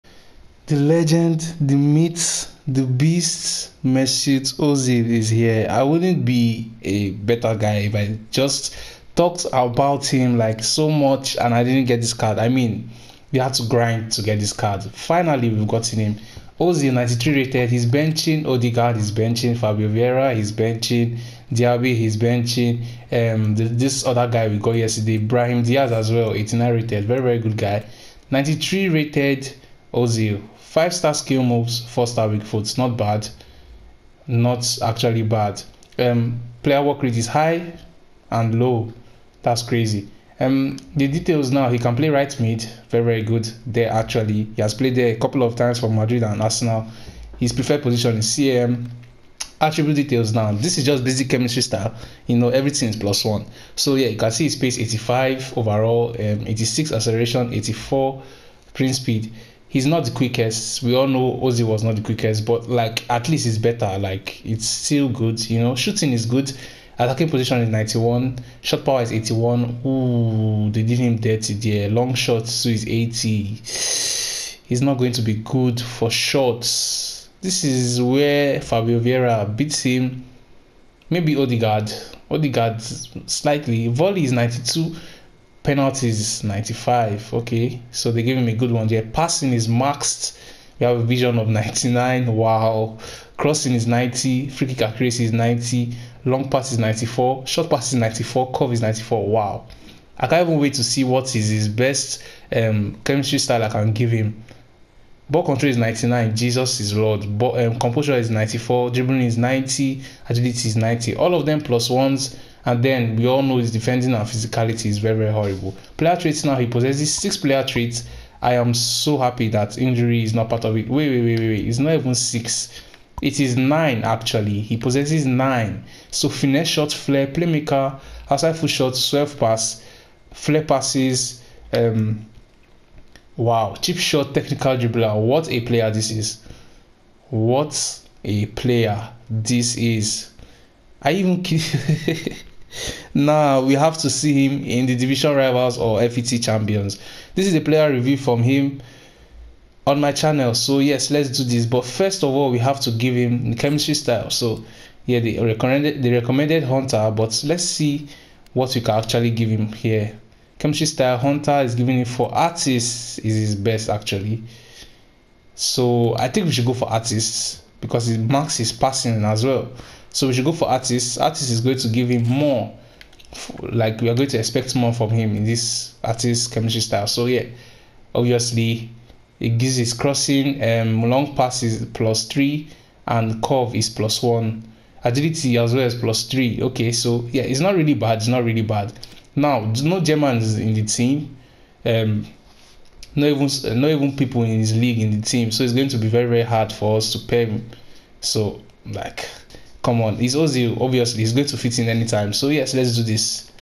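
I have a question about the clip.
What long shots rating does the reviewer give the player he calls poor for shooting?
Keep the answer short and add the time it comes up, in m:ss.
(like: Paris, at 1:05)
80, at 1:12.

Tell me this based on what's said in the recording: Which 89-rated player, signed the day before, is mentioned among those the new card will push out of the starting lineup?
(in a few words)
Brahim Diaz.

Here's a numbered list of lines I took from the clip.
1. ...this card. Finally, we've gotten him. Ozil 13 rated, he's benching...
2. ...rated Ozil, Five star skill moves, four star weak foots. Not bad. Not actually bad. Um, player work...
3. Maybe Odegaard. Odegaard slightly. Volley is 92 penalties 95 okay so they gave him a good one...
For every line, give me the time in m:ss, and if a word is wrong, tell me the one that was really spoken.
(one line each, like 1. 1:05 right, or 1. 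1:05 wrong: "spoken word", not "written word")
1. 0:14 wrong: "93", not "13"
2. 0:28 right
3. 1:21 right.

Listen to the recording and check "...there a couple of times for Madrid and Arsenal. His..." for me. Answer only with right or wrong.
right.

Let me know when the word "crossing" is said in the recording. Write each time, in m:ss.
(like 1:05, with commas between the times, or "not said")
1:33, 2:59.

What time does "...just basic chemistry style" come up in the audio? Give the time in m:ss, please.
0:50.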